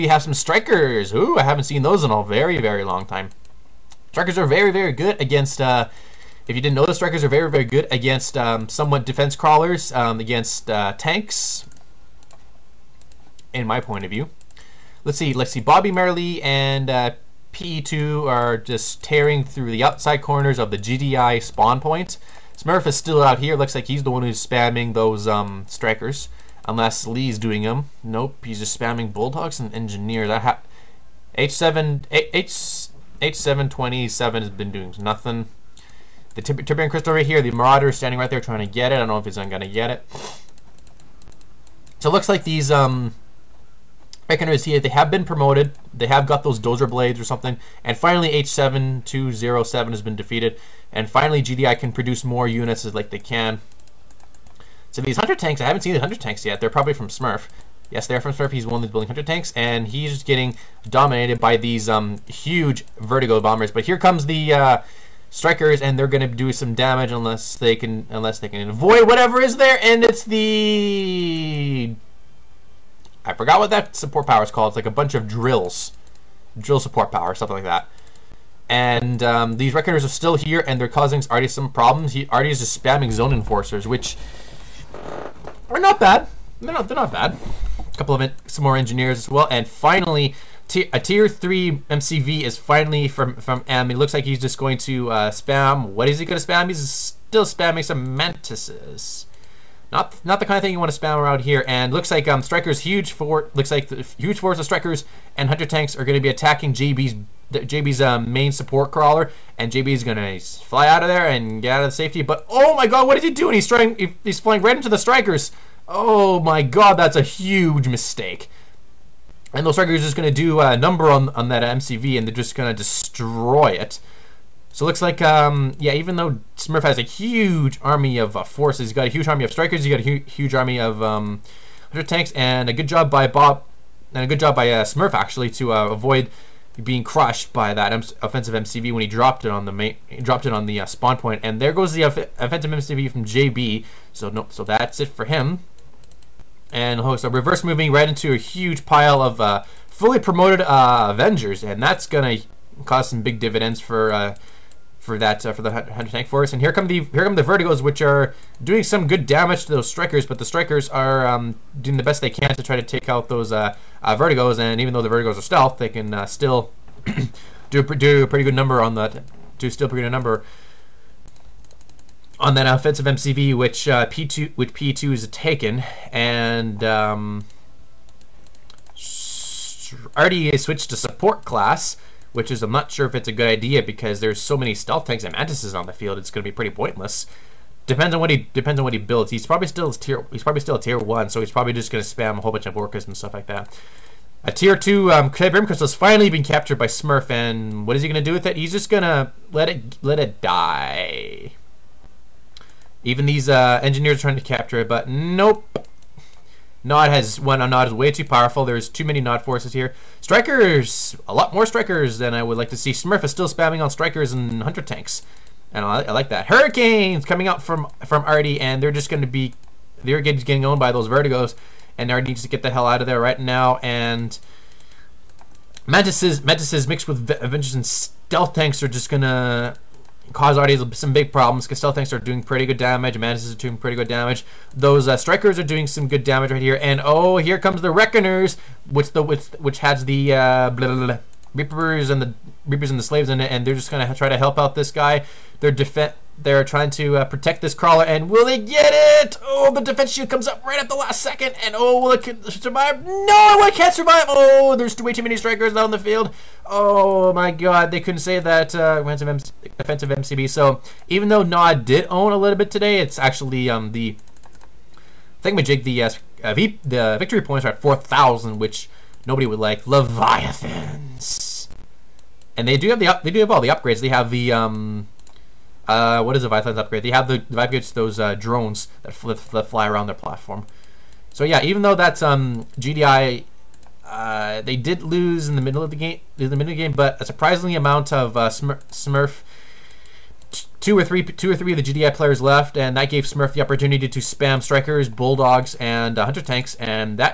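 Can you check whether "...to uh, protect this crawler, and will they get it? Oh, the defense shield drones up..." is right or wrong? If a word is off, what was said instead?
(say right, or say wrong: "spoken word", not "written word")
wrong: "comes", not "drones".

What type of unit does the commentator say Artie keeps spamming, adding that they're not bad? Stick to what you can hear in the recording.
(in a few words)
Zone Enforcers.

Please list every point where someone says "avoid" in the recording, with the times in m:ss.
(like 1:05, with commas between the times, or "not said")
1:08, 2:15.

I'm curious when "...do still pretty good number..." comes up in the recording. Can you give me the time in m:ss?
2:49.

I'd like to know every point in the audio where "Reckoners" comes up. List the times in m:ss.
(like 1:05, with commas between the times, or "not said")
1:19, 3:57.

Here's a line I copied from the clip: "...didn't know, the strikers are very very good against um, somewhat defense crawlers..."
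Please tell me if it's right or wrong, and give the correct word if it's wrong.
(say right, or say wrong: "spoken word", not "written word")
right.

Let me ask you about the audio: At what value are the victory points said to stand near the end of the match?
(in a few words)
4000.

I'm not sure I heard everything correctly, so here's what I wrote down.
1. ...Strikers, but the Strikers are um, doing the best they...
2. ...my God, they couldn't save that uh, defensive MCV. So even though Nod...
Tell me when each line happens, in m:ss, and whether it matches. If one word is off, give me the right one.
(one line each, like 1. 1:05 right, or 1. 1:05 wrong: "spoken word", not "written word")
1. 2:39 right
2. 4:17 right.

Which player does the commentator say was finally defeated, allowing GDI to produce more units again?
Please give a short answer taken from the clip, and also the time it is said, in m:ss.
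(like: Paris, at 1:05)
H7207, at 0:48.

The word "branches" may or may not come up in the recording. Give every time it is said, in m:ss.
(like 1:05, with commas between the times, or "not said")
not said.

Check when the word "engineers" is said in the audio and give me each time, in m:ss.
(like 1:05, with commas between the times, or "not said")
0:29, 1:28, 3:23.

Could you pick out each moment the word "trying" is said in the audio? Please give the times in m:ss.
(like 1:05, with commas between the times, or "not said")
0:38, 1:53, 3:24, 4:06.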